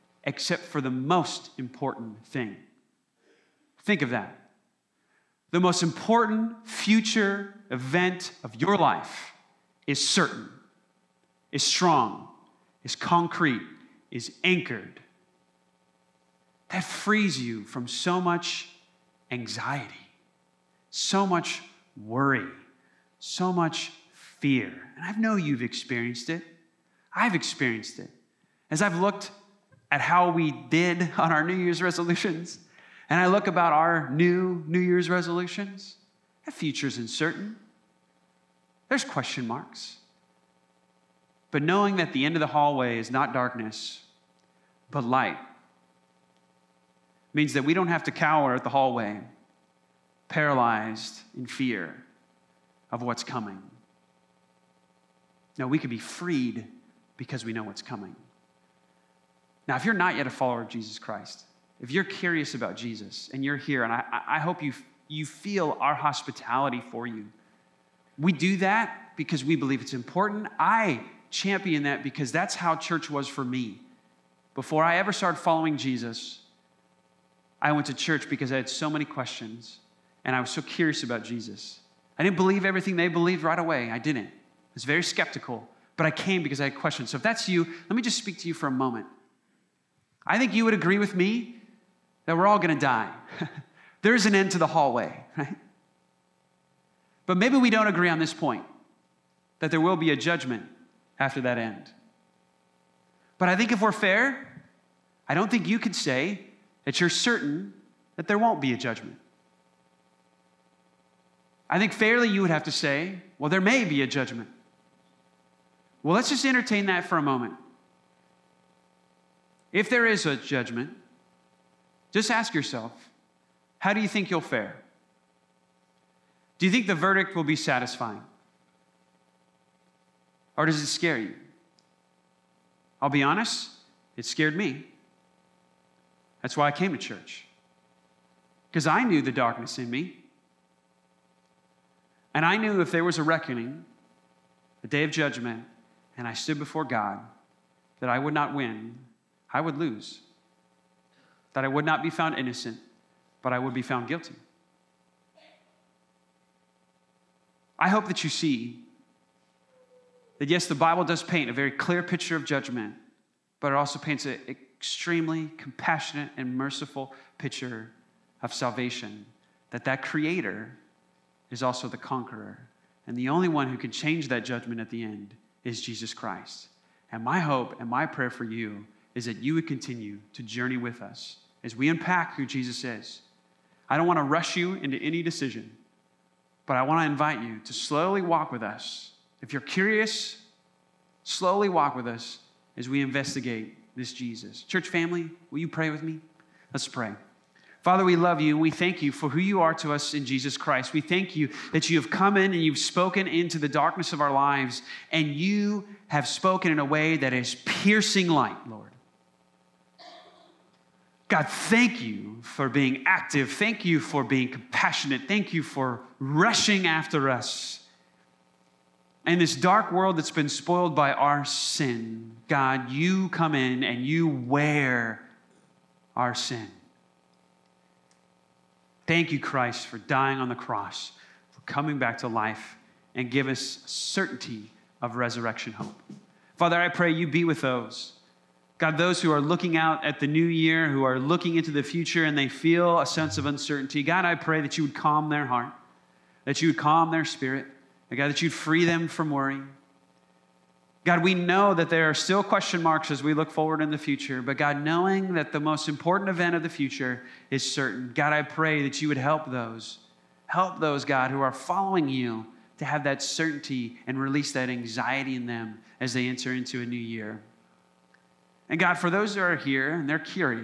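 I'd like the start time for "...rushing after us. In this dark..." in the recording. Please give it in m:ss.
3:36.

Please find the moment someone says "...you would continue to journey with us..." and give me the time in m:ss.
2:59.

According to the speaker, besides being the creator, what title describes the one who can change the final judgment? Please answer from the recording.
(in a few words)
Conqueror.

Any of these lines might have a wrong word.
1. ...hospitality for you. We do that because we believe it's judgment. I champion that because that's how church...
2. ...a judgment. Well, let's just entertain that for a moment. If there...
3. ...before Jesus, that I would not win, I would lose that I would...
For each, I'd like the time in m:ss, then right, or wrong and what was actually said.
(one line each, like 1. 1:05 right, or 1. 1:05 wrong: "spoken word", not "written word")
1. 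1:05 wrong: "important", not "judgment"
2. 1:54 right
3. 2:26 wrong: "God", not "Jesus".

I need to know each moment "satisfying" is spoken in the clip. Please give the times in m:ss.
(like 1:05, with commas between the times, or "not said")
2:07.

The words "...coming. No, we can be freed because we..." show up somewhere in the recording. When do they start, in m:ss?
0:53.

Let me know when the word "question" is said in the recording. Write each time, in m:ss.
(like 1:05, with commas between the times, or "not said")
0:39, 1:19, 1:26, 4:12.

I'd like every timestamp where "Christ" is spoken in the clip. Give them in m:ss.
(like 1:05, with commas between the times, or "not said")
1:00, 2:56, 3:20, 3:49.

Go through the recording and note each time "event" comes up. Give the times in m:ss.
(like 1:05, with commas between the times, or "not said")
0:07, 4:16.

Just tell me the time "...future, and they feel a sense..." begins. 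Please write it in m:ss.
4:01.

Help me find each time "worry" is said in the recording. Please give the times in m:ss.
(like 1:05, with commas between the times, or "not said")
0:21, 4:09.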